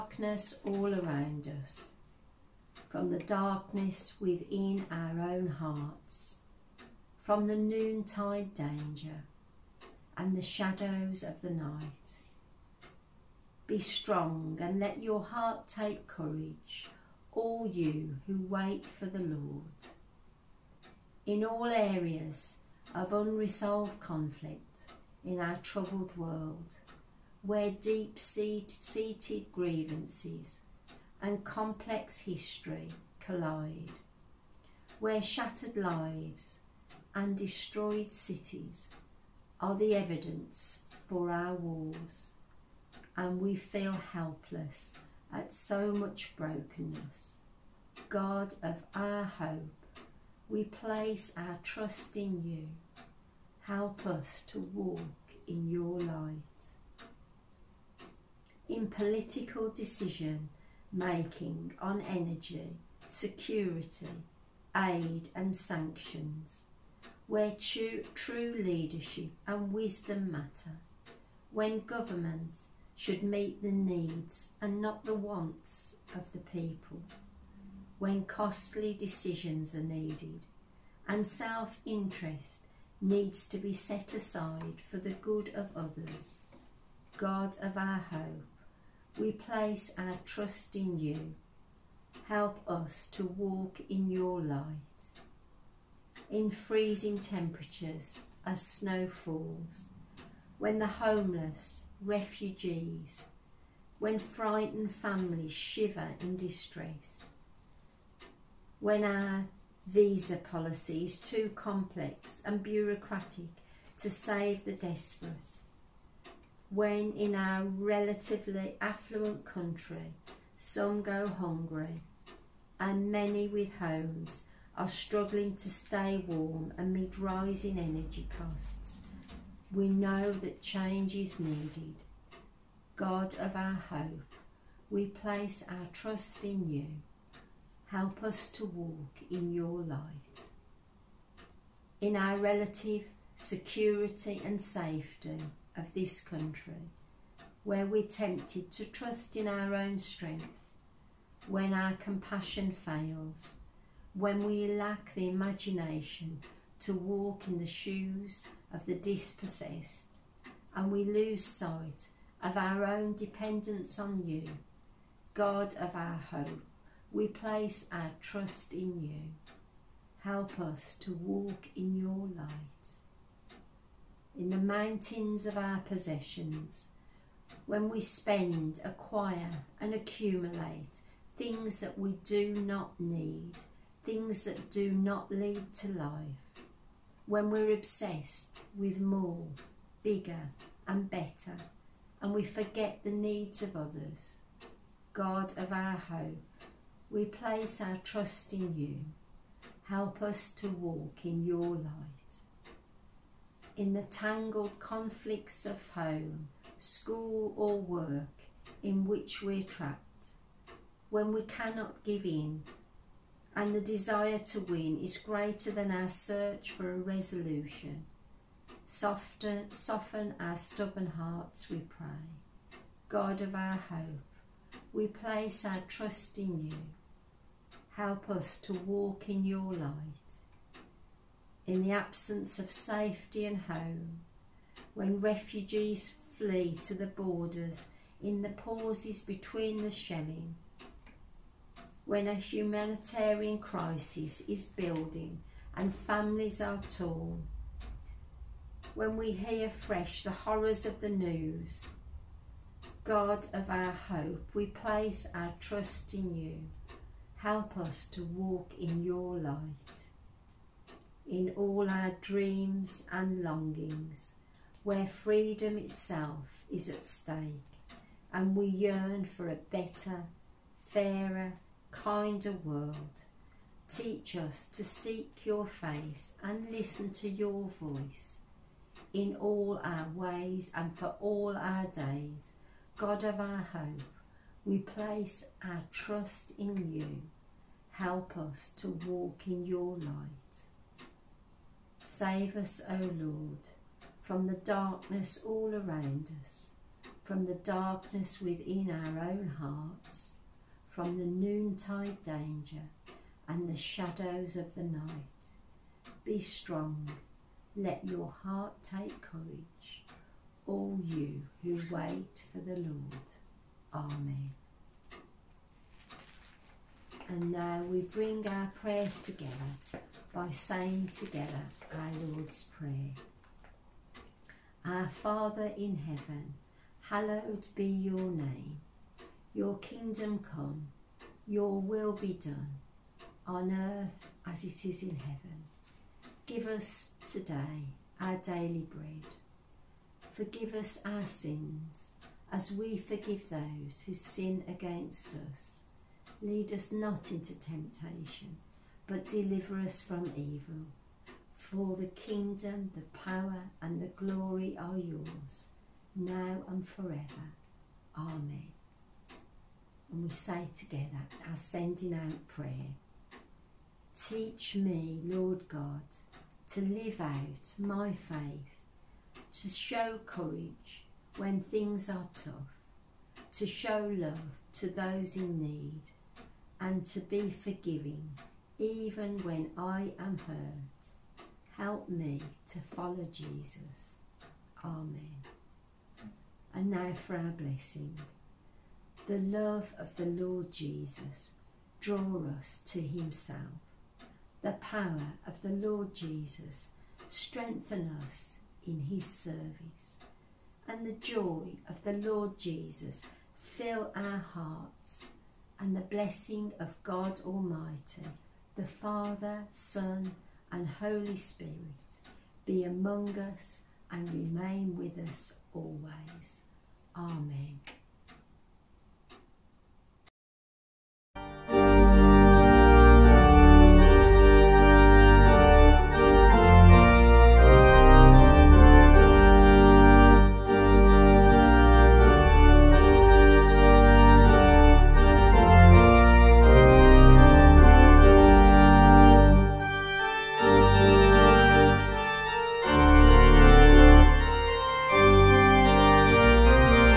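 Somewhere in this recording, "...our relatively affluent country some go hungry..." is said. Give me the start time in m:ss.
1:57.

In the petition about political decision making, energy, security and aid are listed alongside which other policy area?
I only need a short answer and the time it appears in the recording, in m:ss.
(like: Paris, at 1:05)
Sanctions, at 1:05.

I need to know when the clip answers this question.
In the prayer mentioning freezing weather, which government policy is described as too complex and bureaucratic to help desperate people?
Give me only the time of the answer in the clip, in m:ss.
1:49.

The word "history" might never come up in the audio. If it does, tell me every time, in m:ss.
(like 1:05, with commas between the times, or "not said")
0:32.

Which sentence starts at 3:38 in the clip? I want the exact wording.
Soften, soften our stubborn hearts, we pray.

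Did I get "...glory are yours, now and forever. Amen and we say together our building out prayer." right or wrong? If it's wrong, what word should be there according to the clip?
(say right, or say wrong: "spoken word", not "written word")
wrong: "sending", not "building".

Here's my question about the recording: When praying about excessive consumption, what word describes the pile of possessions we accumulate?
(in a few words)
Mountains.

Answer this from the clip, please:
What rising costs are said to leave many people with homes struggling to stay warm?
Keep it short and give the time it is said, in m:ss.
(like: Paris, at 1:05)
Energy costs, at 2:07.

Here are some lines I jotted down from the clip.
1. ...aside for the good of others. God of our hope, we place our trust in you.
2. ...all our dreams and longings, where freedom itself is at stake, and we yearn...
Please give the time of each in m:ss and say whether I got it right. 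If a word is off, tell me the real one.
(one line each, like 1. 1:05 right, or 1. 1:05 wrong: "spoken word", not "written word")
1. 1:24 right
2. 4:21 right.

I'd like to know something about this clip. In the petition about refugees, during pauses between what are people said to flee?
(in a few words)
The shelling.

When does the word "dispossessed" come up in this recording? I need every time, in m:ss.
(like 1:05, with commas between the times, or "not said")
2:38.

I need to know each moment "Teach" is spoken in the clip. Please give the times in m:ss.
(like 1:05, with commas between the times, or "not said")
4:33, 6:04.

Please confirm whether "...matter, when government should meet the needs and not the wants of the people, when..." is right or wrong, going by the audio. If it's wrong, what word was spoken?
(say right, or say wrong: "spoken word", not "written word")
right.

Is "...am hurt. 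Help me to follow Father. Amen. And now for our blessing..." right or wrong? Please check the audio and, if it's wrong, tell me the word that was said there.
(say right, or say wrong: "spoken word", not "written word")
wrong: "Jesus", not "Father".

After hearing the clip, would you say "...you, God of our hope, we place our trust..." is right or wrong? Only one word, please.
right.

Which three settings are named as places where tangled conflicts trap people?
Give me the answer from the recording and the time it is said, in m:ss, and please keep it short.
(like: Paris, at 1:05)
Home, school or work, at 3:25.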